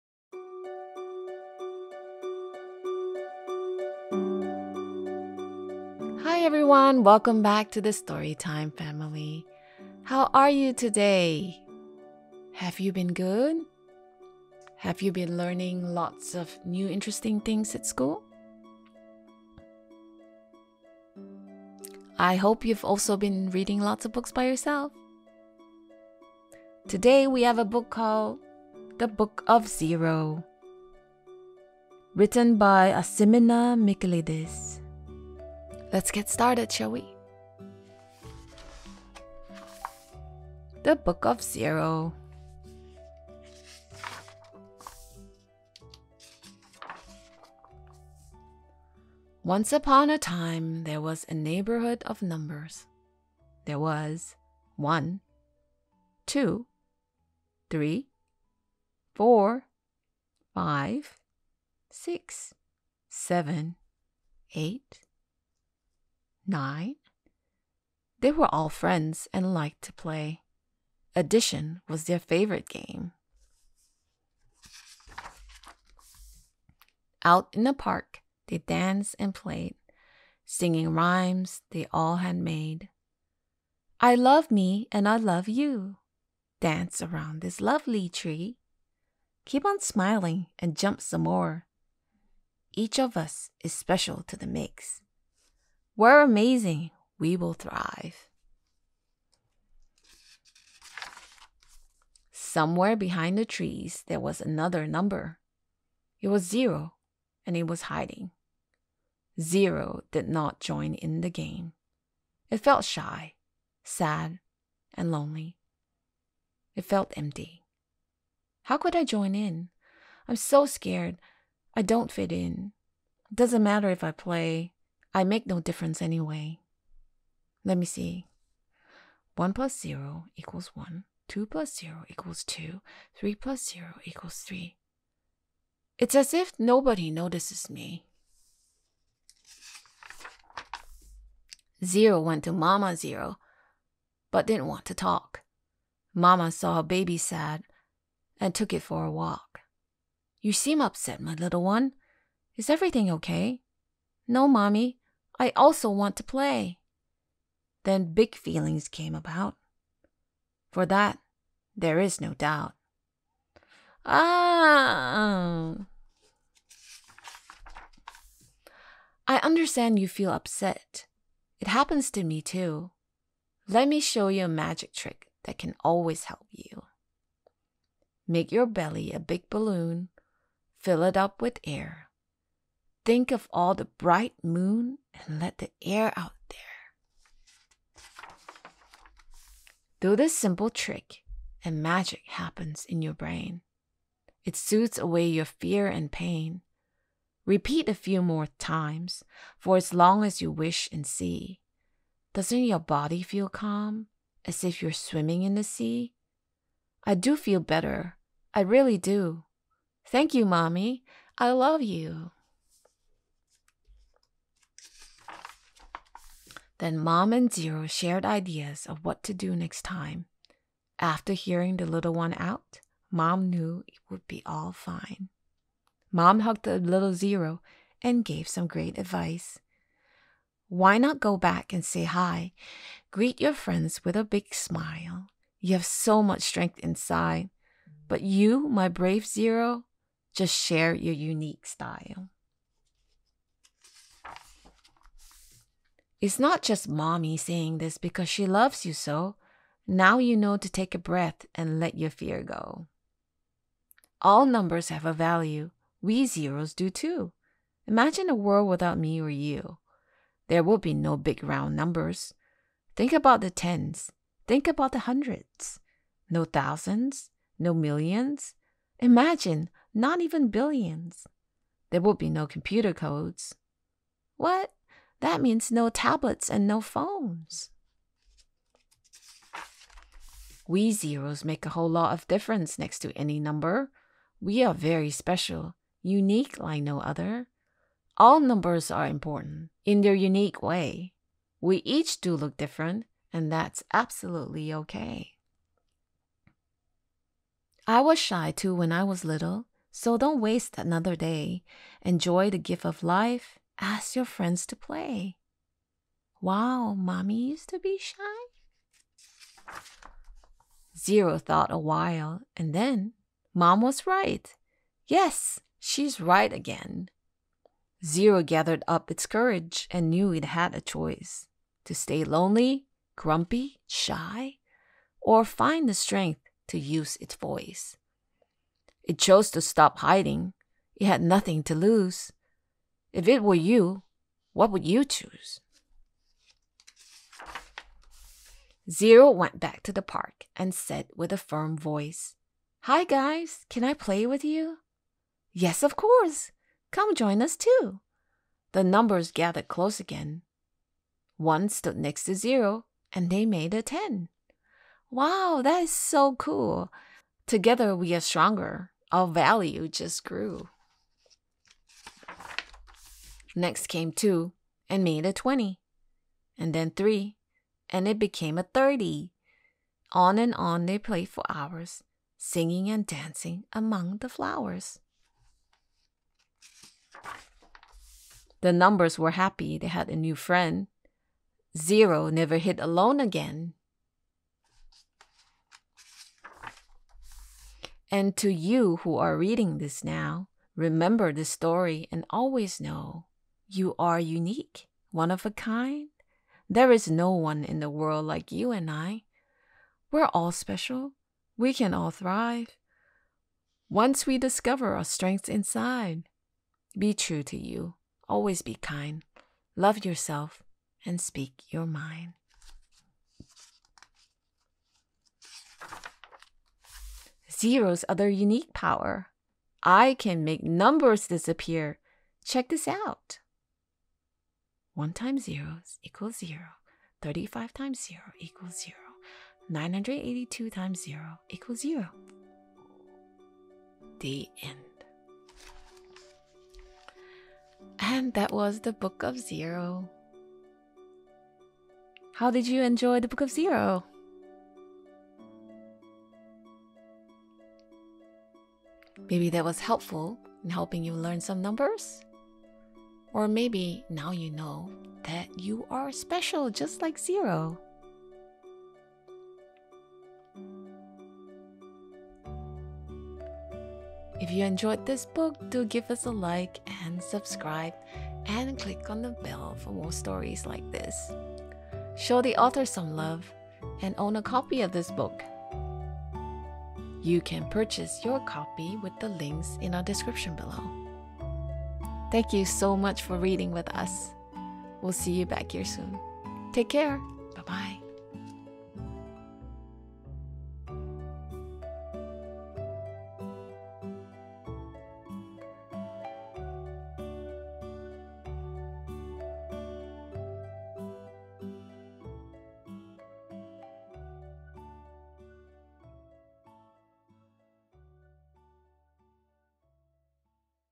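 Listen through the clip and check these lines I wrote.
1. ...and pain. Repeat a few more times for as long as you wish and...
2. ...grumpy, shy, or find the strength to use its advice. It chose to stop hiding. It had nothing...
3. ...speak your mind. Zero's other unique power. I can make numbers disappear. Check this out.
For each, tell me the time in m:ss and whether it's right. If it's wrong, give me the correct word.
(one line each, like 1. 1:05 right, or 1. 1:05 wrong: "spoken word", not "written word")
1. 3:15 right
2. 5:23 wrong: "voice", not "advice"
3. 6:51 right.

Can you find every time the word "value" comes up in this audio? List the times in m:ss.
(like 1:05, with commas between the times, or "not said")
4:15, 5:59.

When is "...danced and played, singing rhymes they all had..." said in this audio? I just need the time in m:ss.
1:18.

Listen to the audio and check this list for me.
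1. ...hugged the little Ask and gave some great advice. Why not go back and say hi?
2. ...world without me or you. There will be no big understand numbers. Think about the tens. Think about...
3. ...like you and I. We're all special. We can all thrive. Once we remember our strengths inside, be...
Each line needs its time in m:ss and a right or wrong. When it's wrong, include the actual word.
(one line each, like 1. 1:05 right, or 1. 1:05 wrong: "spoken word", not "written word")
1. 3:46 wrong: "Zero", not "Ask"
2. 4:18 wrong: "round", not "understand"
3. 6:38 wrong: "discover", not "remember".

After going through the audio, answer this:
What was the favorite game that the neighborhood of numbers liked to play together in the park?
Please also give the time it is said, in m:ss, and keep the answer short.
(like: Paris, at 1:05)
Addition, at 1:11.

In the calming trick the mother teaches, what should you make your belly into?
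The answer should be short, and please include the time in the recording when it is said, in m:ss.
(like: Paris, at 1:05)
a big balloon, at 2:59.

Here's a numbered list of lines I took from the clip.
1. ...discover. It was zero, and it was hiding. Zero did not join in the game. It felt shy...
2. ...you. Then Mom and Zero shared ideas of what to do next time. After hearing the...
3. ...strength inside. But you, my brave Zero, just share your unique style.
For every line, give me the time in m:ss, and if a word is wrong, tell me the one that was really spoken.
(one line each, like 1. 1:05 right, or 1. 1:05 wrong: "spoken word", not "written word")
1. 1:44 wrong: "number", not "discover"
2. 3:31 right
3. 3:56 right.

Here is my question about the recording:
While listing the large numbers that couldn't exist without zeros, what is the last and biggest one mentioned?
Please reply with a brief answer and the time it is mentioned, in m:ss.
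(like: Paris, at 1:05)
billions, at 4:30.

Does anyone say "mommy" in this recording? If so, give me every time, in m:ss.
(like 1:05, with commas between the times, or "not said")
2:34, 3:30, 4:06, 5:06.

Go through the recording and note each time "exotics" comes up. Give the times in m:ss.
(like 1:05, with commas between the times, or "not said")
not said.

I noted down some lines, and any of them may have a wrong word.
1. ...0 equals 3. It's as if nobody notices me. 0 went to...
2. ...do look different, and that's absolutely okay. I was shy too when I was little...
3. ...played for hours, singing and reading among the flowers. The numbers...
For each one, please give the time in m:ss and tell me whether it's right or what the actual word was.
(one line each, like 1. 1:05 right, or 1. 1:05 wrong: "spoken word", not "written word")
1. 2:13 right
2. 4:52 right
3. 6:10 wrong: "dancing", not "reading".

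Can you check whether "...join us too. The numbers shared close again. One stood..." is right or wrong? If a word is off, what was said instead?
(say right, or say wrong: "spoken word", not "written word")
wrong: "gathered", not "shared".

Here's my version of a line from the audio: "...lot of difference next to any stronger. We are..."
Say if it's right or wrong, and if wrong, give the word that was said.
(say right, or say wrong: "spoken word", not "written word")
wrong: "number", not "stronger".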